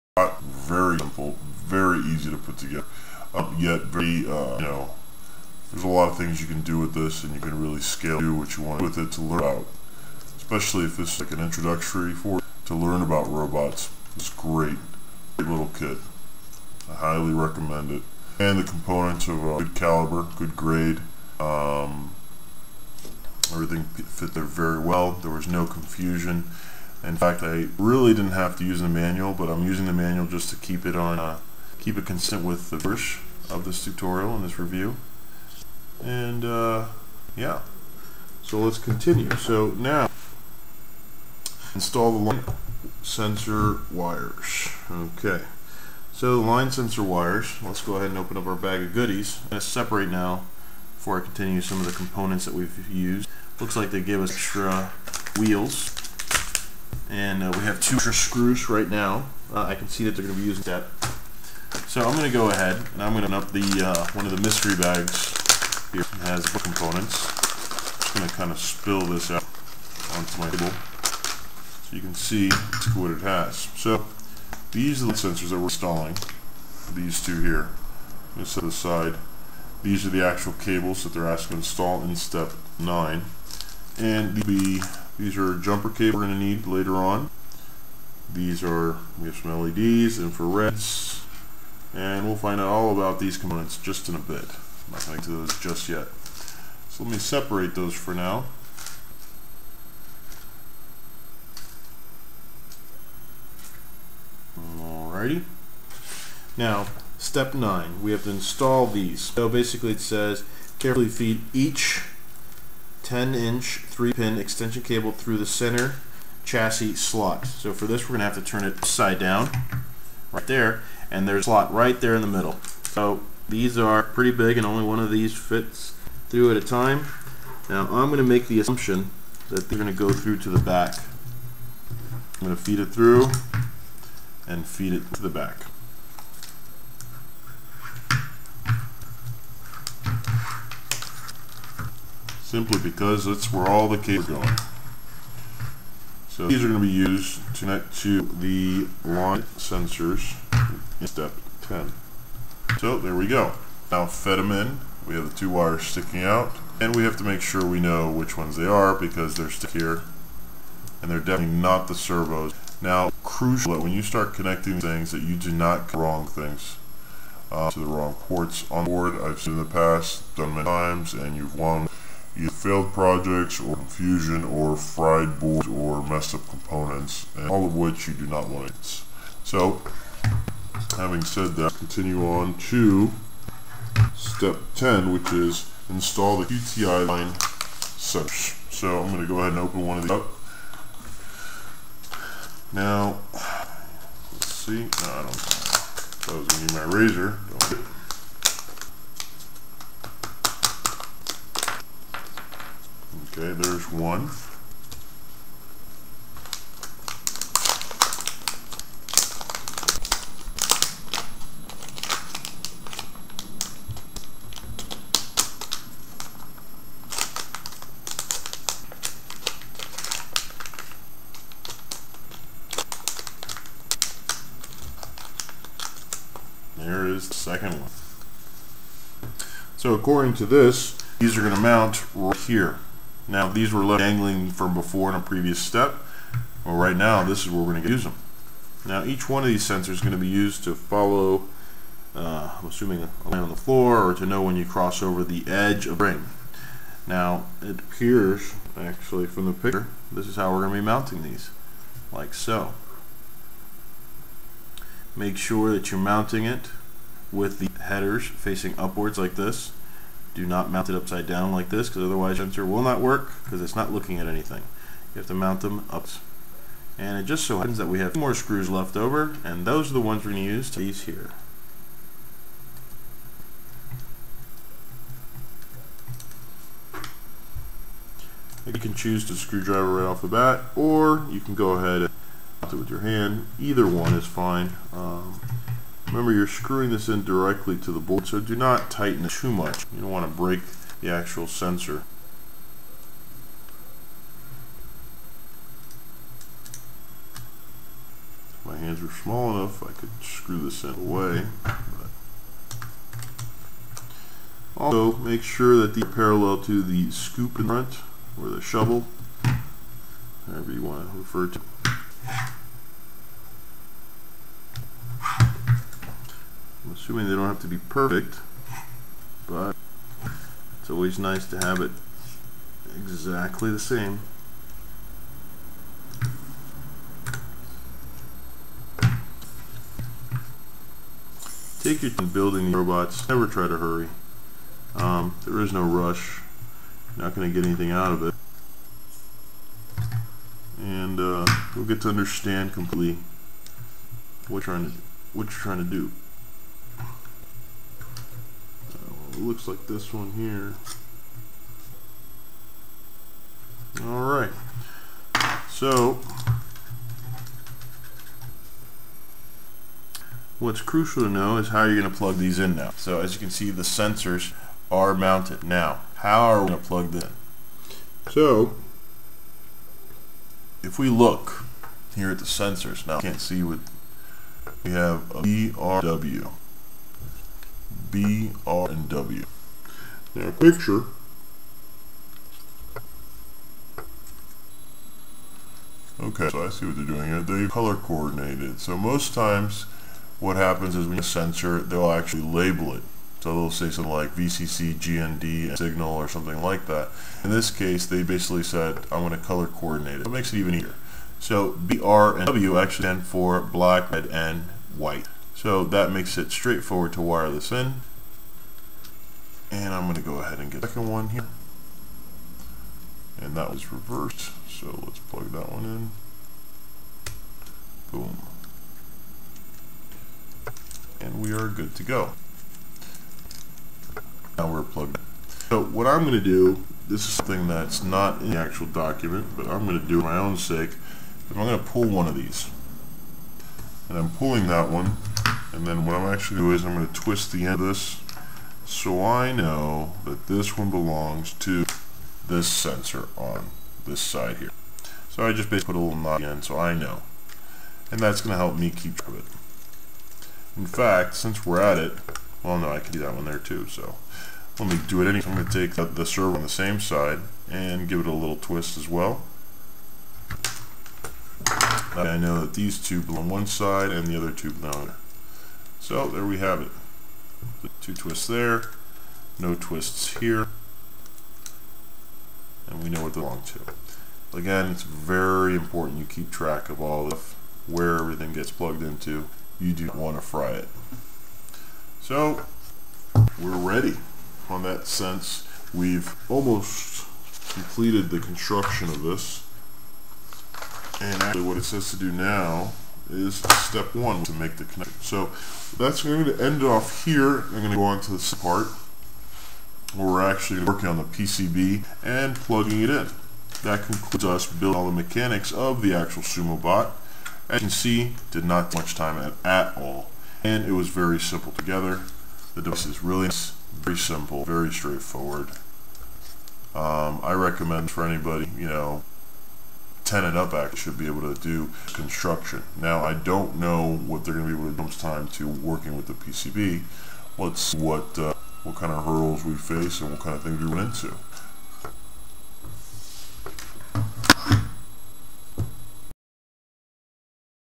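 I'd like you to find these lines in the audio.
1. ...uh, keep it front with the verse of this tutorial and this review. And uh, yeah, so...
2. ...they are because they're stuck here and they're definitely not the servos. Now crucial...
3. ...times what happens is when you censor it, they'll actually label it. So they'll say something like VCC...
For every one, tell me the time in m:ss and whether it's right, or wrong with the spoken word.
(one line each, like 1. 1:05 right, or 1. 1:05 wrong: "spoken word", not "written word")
1. 0:31 wrong: "consistent", not "front"
2. 2:38 right
3. 6:29 right.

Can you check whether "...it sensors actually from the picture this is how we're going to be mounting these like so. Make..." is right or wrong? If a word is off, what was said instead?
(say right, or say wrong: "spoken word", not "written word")
wrong: "appears", not "sensors".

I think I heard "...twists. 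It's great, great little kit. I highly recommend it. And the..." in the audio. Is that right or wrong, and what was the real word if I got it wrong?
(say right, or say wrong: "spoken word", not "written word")
wrong: "robots", not "twists".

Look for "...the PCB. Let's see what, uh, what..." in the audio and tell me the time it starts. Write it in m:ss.
8:46.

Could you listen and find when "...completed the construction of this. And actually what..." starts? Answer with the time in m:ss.
8:07.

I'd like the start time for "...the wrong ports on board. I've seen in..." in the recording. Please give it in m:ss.
2:47.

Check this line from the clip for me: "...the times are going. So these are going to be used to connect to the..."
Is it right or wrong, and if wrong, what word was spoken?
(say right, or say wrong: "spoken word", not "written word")
wrong: "cables", not "times".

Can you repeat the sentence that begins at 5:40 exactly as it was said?
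And uh, you'll get to understand completely what you're trying to, what you're trying to do.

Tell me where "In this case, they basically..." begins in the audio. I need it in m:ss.
6:37.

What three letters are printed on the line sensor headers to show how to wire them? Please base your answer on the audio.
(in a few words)
BRW.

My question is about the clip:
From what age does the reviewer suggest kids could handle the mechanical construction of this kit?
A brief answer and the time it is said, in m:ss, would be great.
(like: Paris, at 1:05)
10, at 8:40.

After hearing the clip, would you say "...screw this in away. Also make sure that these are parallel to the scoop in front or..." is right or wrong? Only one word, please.
right.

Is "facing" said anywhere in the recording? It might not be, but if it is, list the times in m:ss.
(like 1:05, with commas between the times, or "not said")
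4:18.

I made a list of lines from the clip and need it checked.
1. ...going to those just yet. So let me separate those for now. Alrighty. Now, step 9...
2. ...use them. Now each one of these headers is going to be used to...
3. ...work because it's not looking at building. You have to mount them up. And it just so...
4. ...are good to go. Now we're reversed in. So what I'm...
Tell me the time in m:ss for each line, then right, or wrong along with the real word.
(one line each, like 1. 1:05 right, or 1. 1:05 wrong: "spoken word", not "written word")
1. 1:35 right
2. 3:57 wrong: "sensors", not "headers"
3. 4:23 wrong: "anything", not "building"
4. 7:01 wrong: "plugged", not "reversed".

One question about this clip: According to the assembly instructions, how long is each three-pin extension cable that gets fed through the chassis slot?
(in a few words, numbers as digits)
10 inch.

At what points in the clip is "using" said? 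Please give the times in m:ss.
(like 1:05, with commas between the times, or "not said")
0:29, 1:00.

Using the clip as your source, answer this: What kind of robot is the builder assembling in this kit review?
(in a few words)
Sumo bot.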